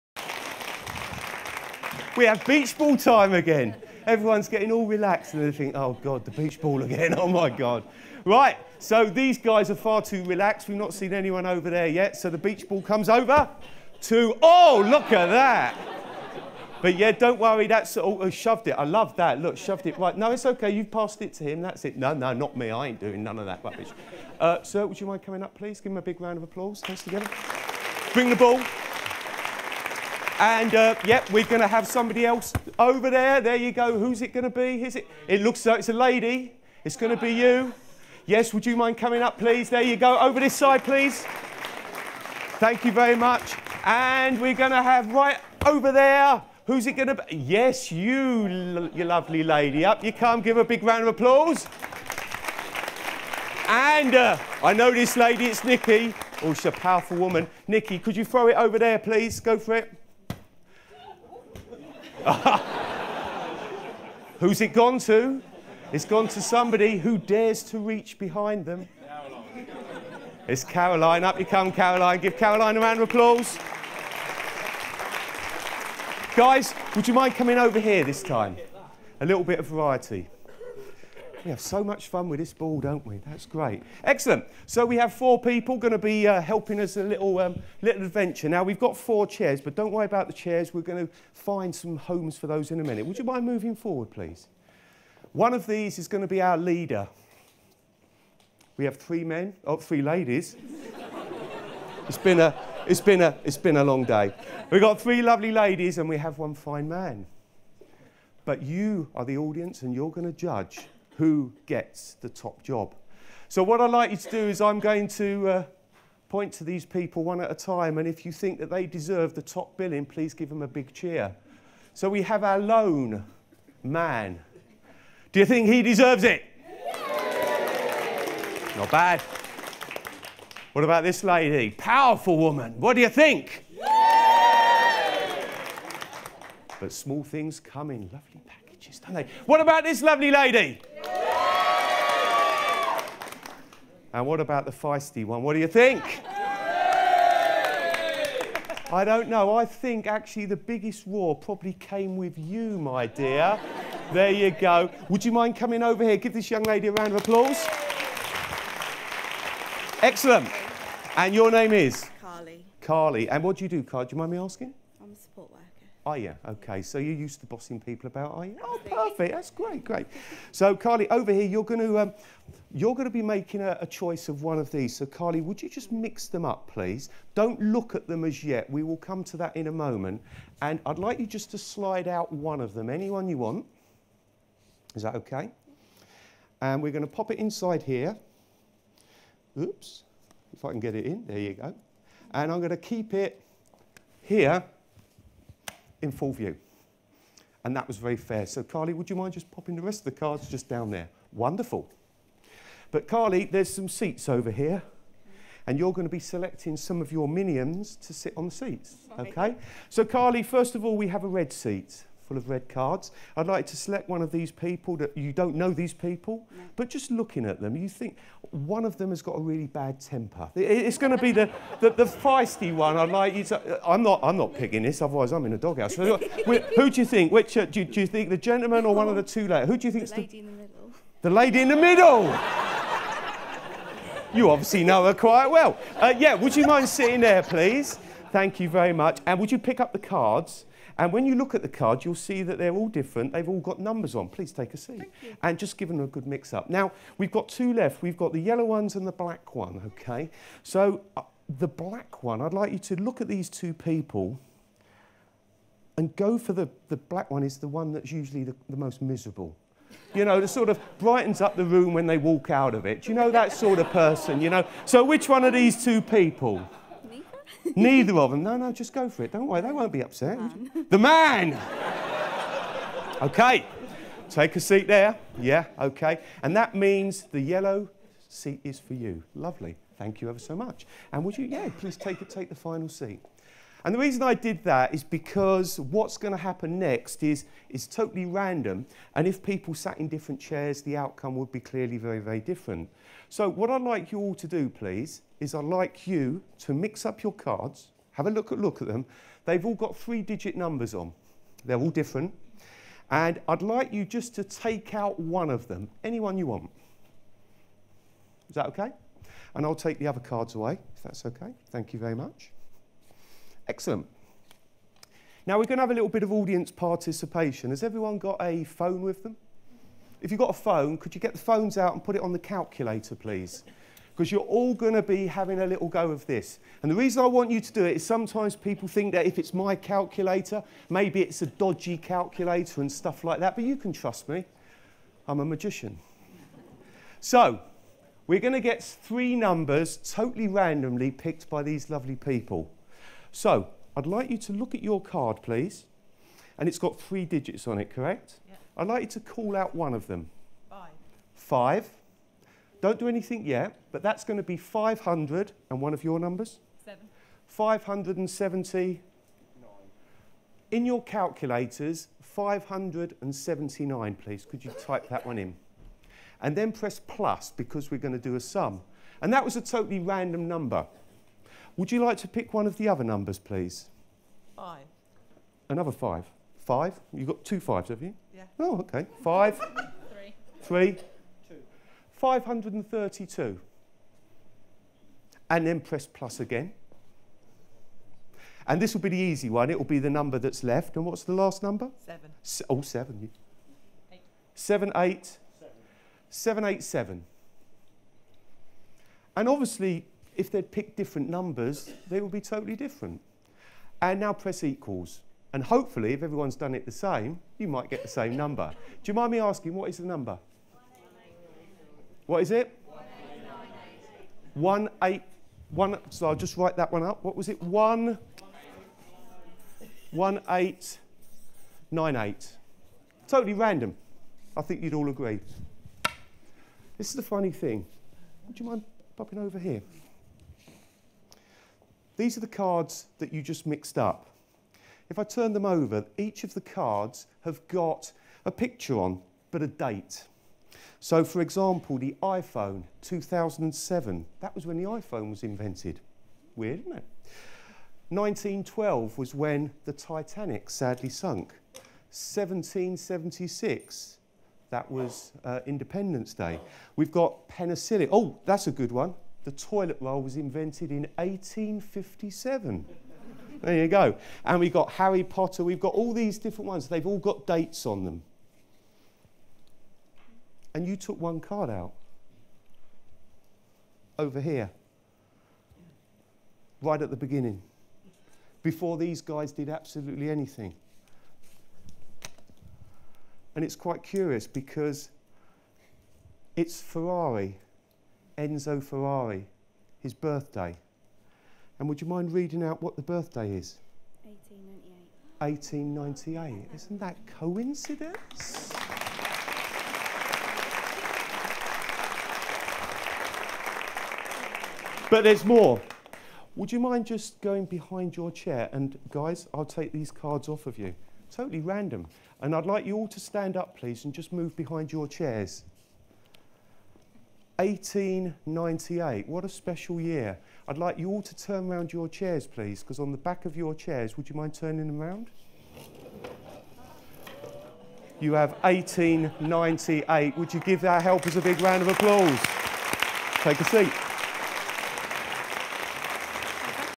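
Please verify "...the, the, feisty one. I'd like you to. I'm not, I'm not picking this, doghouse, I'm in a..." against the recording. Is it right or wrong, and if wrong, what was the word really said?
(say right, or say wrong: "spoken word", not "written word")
wrong: "otherwise", not "doghouse".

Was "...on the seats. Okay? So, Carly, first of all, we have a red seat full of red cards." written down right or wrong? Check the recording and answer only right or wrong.
right.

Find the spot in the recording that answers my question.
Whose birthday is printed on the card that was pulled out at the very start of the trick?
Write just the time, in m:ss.
8:08.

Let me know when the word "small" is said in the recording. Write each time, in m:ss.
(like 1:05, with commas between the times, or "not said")
2:16.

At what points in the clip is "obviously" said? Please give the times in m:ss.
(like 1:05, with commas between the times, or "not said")
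3:54, 6:39.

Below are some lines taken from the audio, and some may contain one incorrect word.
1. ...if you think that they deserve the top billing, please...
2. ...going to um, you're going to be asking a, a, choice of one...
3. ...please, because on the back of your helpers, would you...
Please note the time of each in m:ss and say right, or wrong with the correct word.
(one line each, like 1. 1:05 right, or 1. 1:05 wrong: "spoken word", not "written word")
1. 1:58 right
2. 2:51 wrong: "making", not "asking"
3. 8:42 wrong: "chairs", not "helpers".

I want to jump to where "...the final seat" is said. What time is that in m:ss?
4:42.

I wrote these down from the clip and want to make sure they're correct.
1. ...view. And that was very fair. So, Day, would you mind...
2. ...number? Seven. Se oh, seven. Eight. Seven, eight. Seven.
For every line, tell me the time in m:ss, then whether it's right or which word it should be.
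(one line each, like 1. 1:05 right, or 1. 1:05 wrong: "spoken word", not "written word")
1. 3:16 wrong: "Carly", not "Day"
2. 6:31 right.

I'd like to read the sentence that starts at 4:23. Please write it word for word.
you know that sort of person, you know?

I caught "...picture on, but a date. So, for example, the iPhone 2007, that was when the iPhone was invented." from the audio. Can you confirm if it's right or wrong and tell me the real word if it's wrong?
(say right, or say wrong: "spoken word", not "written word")
right.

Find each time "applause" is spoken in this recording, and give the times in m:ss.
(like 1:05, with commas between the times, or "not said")
0:26, 0:51, 1:13, 2:37, 8:51.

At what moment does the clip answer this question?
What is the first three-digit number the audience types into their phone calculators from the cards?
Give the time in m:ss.
6:02.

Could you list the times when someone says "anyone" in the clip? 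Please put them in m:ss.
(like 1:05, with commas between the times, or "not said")
0:11, 3:02, 5:06.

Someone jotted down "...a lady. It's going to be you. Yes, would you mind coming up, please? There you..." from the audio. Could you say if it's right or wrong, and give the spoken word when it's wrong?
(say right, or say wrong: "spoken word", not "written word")
right.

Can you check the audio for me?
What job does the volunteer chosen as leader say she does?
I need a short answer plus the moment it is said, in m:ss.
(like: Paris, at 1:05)
Support worker, at 2:45.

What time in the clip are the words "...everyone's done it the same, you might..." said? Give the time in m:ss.
6:46.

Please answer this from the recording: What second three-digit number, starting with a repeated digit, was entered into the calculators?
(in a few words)
532.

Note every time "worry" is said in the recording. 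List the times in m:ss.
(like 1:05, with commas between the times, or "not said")
0:17, 1:29, 4:29.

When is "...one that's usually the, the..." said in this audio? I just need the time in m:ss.
4:17.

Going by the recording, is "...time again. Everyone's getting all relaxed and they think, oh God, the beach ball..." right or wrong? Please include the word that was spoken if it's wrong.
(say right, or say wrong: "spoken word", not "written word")
right.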